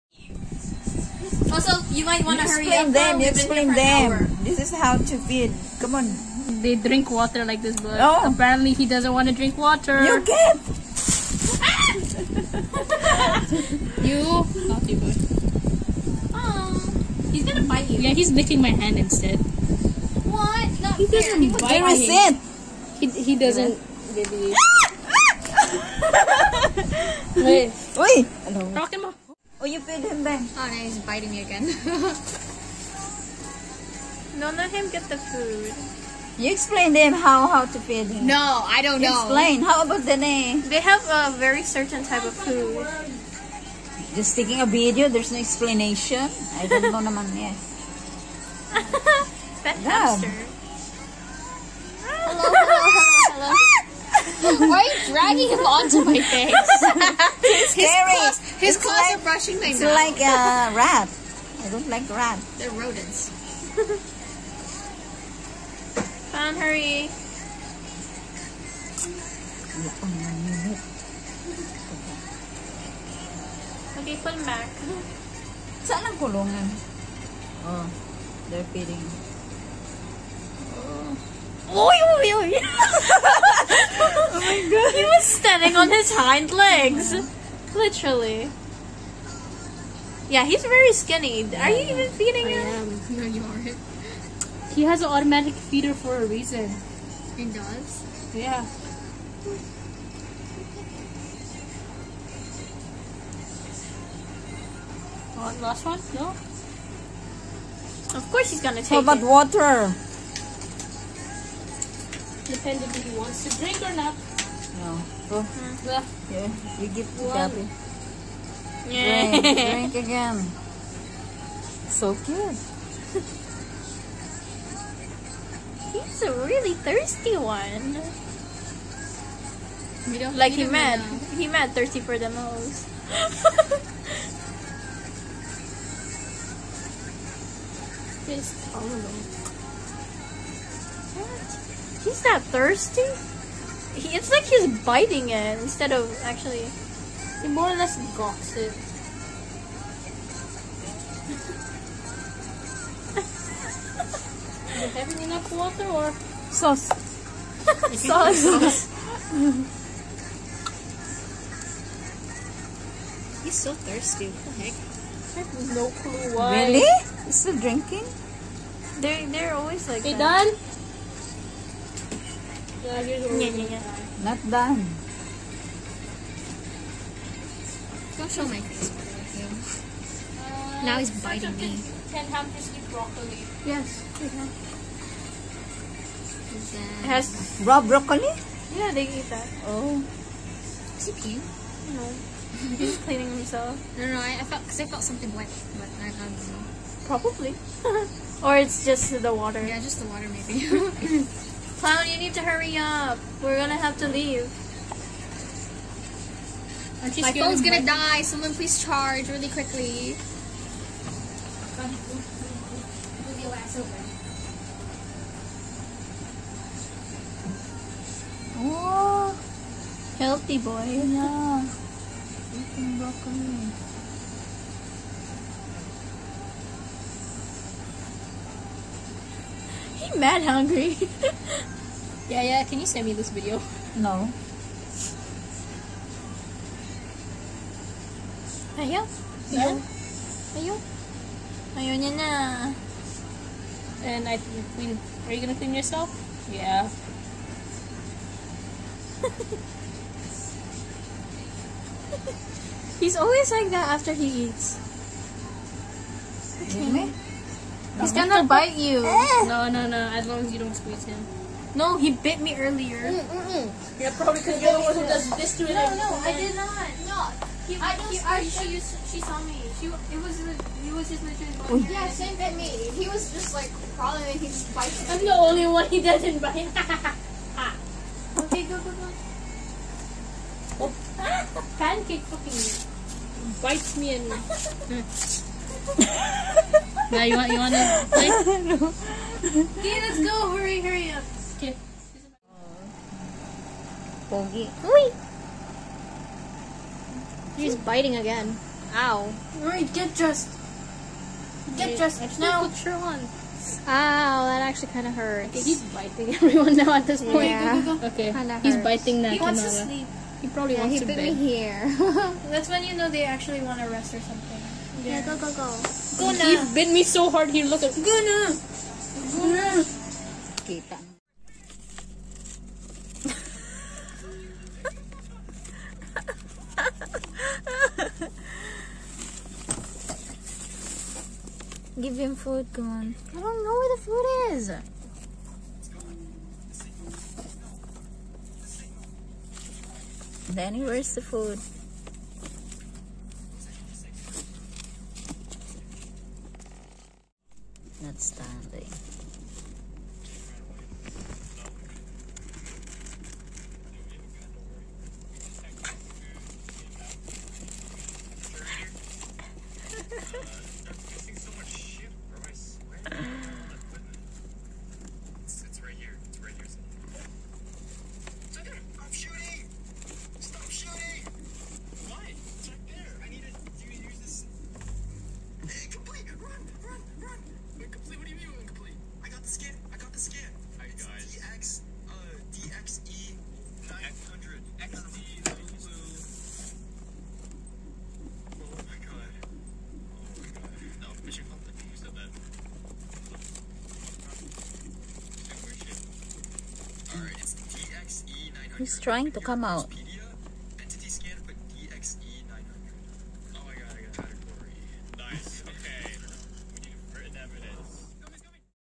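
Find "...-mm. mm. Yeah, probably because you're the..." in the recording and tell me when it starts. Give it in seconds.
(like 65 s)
263 s.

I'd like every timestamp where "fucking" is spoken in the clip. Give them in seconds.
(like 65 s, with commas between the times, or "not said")
282 s.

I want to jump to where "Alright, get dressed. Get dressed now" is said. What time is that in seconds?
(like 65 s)
299 s.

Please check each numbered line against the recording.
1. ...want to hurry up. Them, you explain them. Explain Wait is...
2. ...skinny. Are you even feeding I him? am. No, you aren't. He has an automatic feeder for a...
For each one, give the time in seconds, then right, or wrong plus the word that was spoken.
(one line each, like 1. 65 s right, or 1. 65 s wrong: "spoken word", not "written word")
1. 2 s wrong: "This", not "Wait"
2. 90 s right.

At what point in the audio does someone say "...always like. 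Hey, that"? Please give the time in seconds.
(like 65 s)
169 s.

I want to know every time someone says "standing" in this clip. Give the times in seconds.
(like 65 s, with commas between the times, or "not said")
85 s, 348 s.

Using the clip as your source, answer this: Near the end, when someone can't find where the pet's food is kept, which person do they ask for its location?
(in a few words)
Danny.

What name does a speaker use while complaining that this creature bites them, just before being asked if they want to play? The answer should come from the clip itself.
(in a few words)
Pancake.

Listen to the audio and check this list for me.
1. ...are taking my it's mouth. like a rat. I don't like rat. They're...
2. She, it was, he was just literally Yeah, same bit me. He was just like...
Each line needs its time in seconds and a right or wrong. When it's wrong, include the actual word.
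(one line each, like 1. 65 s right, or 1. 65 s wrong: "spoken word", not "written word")
1. 59 s wrong: "brushing", not "taking"
2. 269 s right.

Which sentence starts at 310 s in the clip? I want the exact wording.
He probably yeah, wants he to bed.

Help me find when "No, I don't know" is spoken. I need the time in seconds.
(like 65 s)
38 s.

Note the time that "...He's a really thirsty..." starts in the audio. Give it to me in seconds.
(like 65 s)
125 s.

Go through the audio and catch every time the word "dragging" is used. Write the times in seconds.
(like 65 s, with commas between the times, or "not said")
55 s.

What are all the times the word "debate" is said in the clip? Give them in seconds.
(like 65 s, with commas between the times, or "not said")
not said.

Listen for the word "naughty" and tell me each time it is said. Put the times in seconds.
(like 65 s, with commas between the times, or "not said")
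14 s.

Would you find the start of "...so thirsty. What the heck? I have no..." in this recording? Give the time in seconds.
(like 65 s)
163 s.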